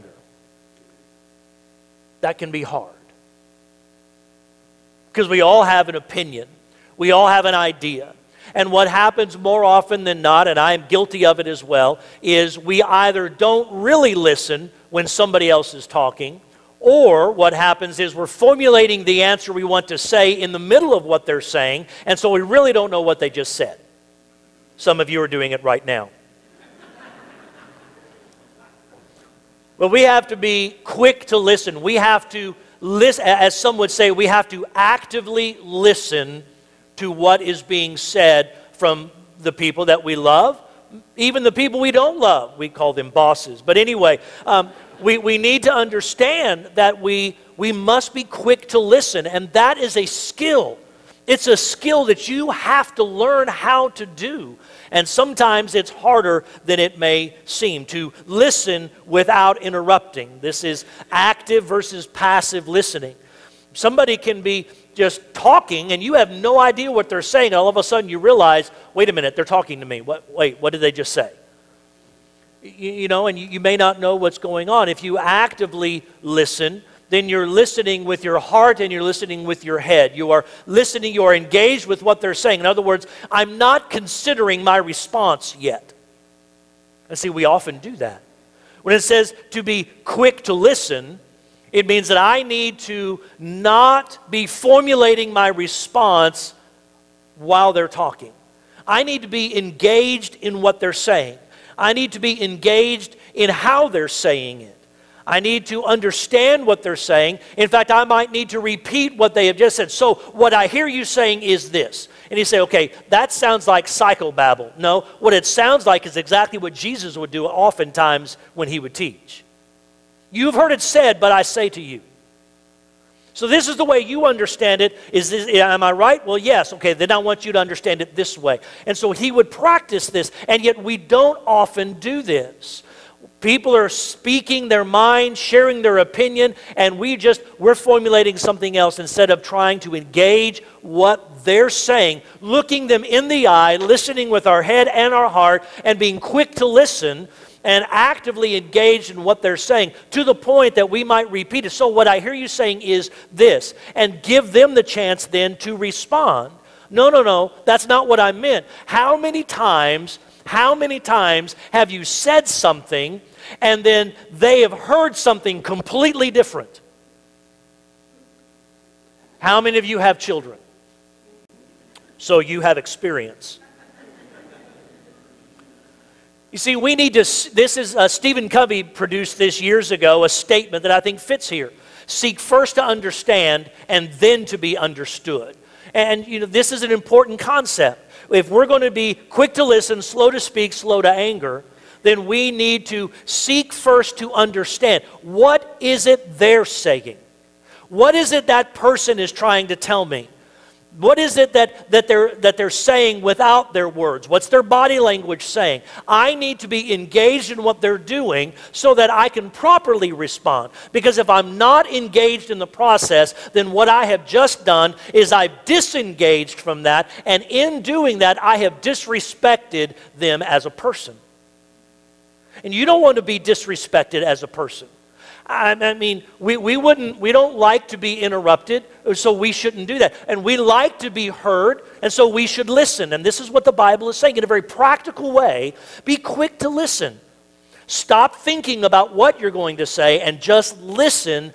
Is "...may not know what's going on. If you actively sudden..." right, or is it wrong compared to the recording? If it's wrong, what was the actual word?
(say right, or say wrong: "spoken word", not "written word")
wrong: "listen", not "sudden".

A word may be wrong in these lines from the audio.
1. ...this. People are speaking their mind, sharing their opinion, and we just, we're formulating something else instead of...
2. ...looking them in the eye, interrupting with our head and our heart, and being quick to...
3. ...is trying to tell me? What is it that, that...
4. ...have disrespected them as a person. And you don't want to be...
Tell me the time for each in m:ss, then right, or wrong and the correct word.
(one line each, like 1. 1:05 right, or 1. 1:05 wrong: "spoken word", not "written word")
1. 2:12 right
2. 2:22 wrong: "listening", not "interrupting"
3. 3:19 right
4. 3:38 right.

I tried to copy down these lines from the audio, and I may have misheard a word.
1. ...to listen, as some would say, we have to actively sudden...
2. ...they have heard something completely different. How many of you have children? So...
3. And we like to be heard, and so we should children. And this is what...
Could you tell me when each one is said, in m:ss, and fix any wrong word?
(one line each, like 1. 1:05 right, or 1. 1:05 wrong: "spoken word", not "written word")
1. 0:32 wrong: "listen", not "sudden"
2. 2:44 right
3. 3:50 wrong: "listen", not "children".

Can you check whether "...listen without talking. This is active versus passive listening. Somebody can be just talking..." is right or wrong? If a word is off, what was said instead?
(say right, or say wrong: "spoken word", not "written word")
wrong: "interrupting", not "talking".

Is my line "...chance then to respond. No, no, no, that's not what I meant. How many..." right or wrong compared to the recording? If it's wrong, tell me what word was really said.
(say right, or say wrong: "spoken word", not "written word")
right.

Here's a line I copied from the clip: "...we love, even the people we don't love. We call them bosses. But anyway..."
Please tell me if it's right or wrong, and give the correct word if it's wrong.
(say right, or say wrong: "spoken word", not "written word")
right.